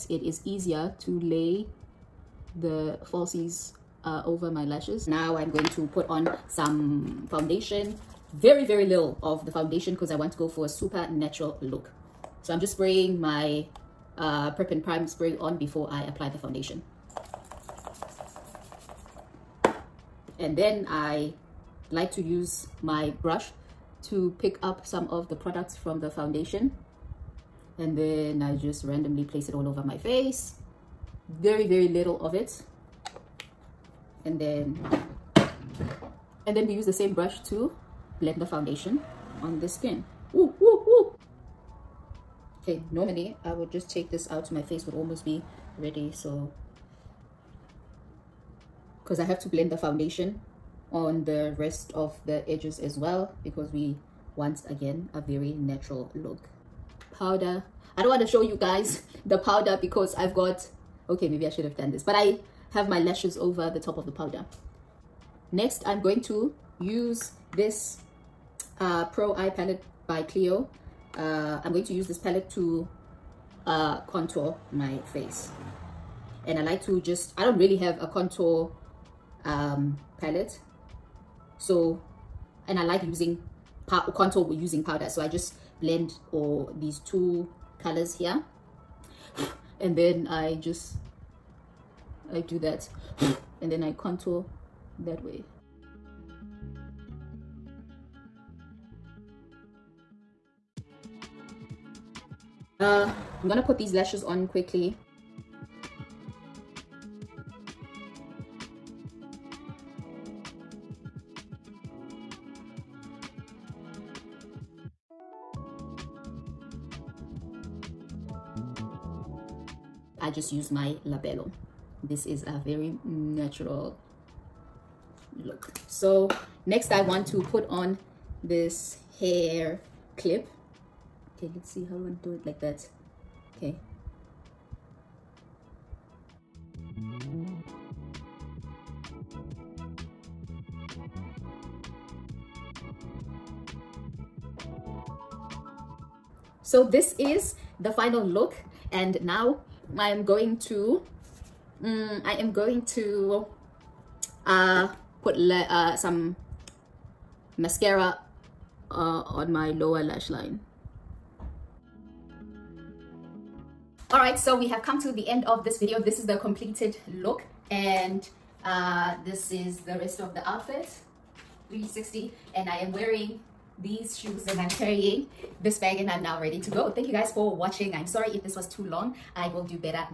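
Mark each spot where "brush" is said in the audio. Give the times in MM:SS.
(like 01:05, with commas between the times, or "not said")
00:23, 00:37.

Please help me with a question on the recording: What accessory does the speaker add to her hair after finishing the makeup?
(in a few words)
hair clip.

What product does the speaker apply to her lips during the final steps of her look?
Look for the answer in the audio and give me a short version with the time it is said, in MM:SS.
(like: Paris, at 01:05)
labello, at 02:01.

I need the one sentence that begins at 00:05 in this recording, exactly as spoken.
Now I'm going to put on some foundation.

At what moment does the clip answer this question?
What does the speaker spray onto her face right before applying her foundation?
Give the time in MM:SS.
00:14.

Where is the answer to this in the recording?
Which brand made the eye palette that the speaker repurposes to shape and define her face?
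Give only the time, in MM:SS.
01:10.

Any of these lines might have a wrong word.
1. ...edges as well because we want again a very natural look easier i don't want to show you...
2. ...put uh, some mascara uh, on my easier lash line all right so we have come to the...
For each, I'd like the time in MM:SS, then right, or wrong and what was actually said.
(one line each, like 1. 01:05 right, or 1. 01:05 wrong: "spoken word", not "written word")
1. 00:52 wrong: "powder", not "easier"
2. 02:35 wrong: "lower", not "easier".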